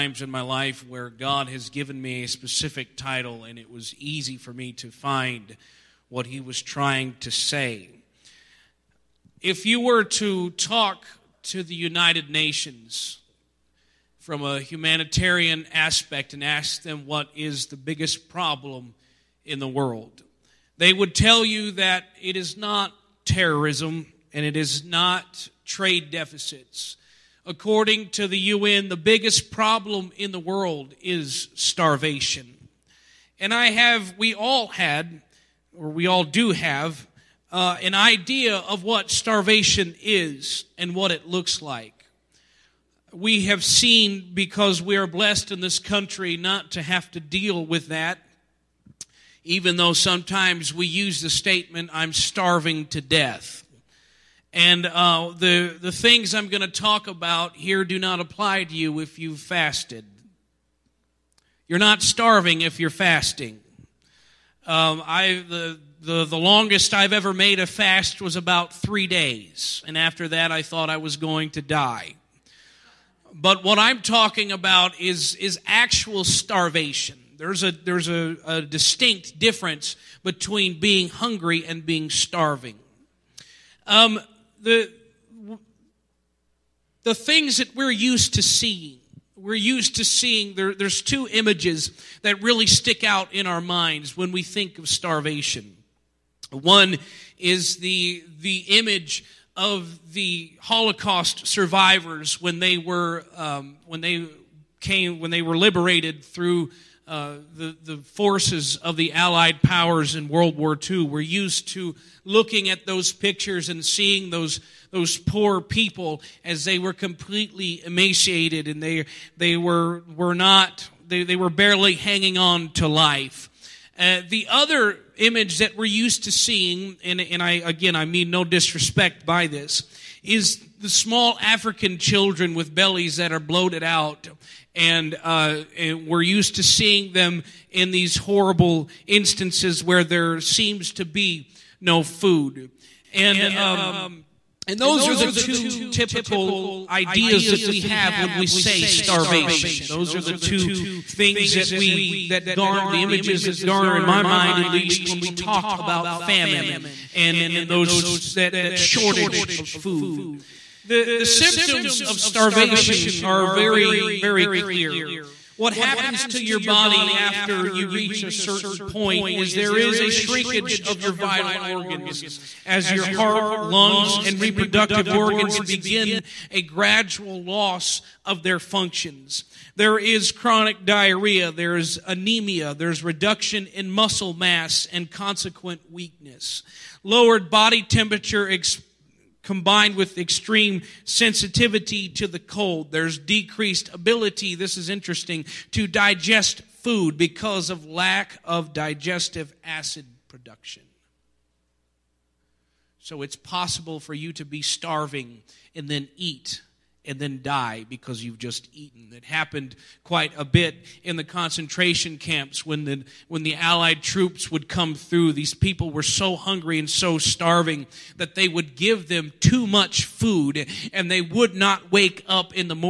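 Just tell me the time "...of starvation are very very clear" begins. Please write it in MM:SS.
02:42.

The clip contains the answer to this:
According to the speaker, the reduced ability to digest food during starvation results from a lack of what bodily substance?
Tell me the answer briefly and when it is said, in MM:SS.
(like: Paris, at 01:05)
Digestive acid, at 03:18.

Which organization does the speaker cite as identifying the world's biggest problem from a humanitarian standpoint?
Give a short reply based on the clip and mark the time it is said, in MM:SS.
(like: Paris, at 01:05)
United Nations, at 00:11.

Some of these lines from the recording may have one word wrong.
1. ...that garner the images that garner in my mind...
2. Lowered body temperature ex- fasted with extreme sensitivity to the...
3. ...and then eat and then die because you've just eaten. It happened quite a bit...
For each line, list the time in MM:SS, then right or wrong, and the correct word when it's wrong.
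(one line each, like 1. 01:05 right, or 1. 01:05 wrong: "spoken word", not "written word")
1. 02:32 right
2. 03:07 wrong: "combined", not "fasted"
3. 03:25 right.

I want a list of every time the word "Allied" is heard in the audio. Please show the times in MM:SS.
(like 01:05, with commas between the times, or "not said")
01:49, 03:33.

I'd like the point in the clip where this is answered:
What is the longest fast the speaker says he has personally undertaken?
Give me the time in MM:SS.
01:08.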